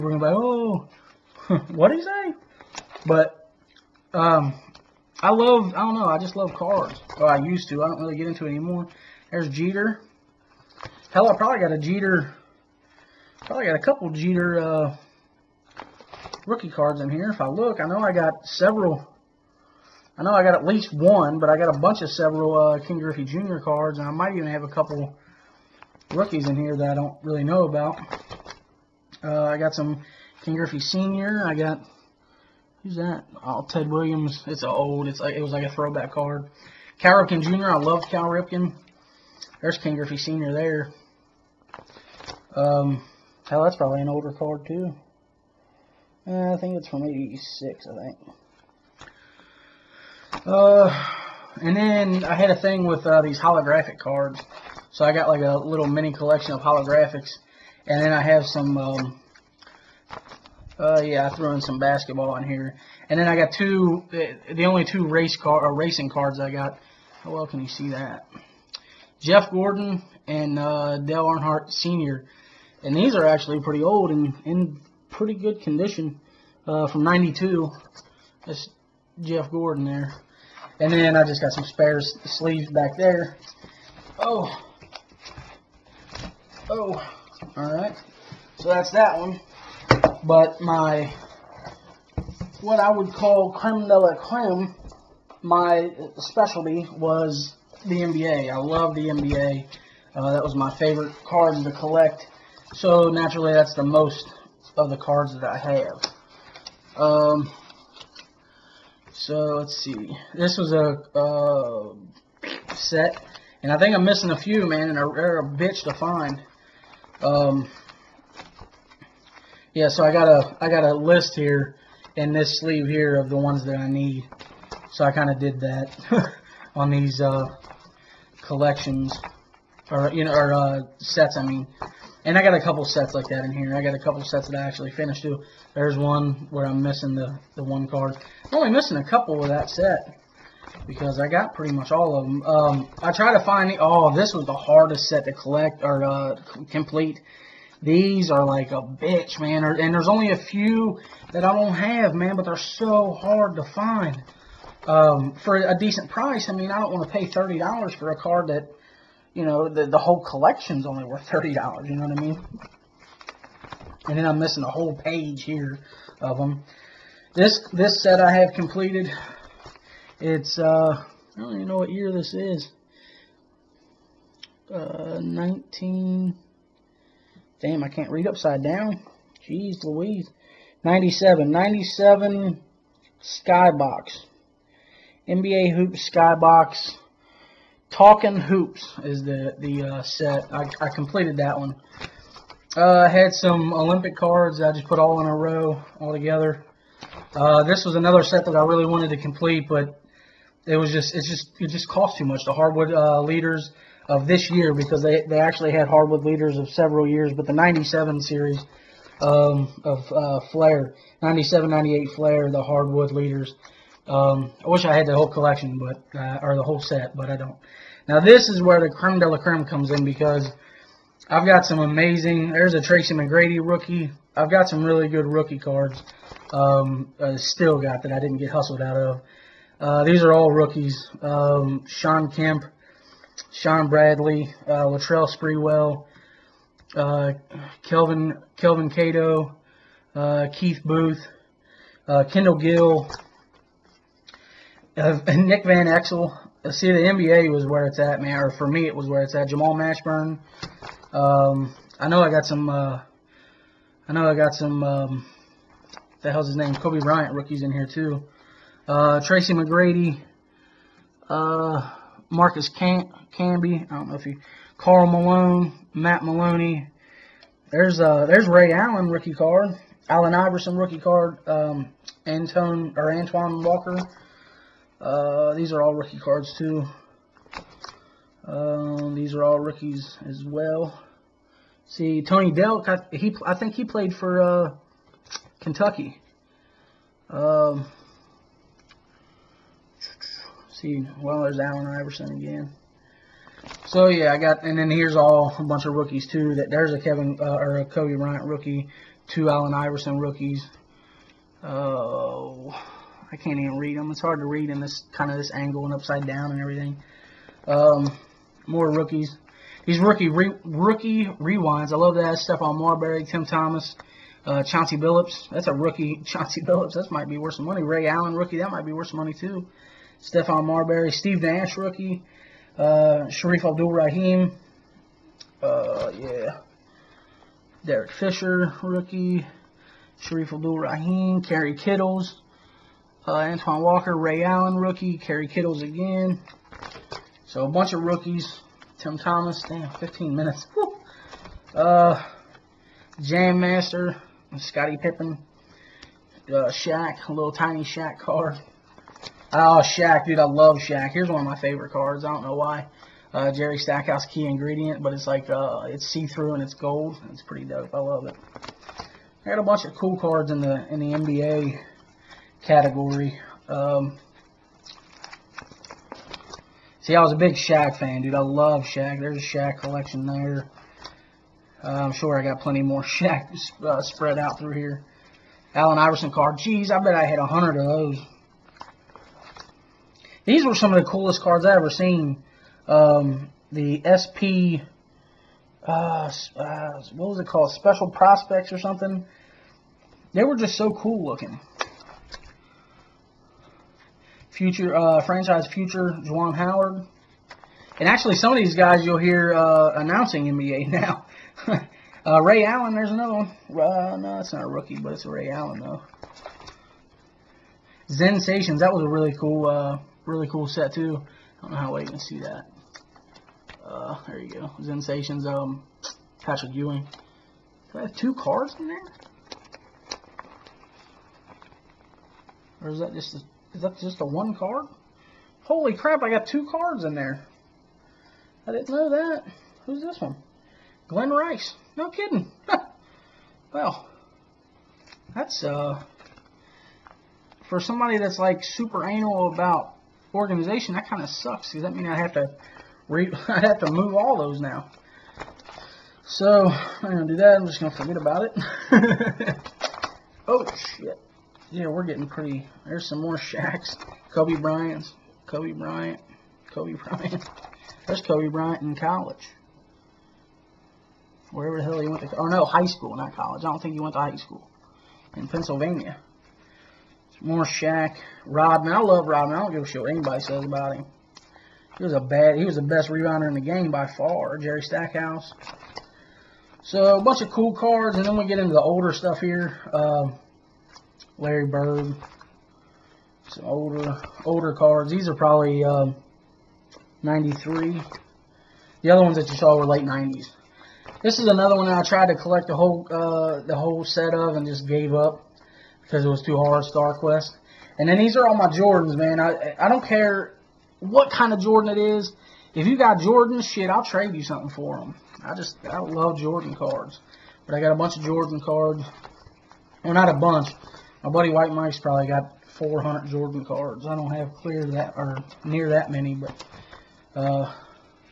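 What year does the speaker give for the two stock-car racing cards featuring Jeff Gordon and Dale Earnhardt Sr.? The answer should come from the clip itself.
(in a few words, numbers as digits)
1992.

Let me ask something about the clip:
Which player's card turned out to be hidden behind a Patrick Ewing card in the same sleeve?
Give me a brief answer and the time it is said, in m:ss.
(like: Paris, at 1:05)
Glen Rice, at 7:11.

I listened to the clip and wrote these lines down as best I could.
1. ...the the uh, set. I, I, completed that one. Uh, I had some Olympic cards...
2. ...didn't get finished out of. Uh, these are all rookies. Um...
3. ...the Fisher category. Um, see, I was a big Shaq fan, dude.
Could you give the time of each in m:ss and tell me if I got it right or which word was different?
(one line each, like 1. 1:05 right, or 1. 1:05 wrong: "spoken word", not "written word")
1. 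3:09 right
2. 3:48 wrong: "hustled", not "finished"
3. 6:00 wrong: "NBA", not "Fisher".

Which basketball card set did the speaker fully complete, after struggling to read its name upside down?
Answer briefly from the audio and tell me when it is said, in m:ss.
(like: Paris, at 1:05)
NBA Hoop Skybox Talking Hoops, at 3:05.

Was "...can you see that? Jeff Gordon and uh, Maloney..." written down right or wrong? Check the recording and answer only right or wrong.
wrong.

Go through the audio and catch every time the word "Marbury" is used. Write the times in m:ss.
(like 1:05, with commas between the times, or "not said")
5:12, 5:20.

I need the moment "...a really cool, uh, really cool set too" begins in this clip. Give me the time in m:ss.
6:49.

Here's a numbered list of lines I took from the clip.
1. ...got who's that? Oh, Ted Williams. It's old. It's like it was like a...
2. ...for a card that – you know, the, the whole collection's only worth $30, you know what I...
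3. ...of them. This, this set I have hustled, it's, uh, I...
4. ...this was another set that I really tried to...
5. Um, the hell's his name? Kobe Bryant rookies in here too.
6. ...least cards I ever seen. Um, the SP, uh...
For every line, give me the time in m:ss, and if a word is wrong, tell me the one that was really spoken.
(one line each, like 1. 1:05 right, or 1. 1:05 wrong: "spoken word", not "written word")
1. 0:31 right
2. 2:37 right
3. 2:46 wrong: "completed", not "hustled"
4. 3:17 wrong: "wanted", not "tried"
5. 4:14 right
6. 6:21 wrong: "coolest", not "least".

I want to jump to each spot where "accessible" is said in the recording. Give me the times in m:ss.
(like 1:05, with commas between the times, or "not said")
not said.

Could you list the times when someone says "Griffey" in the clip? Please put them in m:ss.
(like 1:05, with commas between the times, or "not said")
0:22, 0:30, 0:39.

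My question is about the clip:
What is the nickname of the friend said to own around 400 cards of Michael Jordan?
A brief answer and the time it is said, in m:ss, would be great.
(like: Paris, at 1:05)
White Mike, at 8:31.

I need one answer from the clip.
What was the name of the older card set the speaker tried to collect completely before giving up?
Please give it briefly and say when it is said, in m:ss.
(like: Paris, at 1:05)
Star Quest, at 8:16.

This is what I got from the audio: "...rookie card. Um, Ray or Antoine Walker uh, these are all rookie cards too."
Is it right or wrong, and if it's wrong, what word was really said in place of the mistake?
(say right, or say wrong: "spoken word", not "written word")
wrong: "Antone", not "Ray".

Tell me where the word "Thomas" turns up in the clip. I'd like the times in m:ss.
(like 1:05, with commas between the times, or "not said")
5:13, 5:39.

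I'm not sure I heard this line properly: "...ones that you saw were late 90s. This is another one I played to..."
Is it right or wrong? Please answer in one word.
wrong.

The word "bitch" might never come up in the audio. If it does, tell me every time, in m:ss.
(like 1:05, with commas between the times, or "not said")
1:55, 2:28.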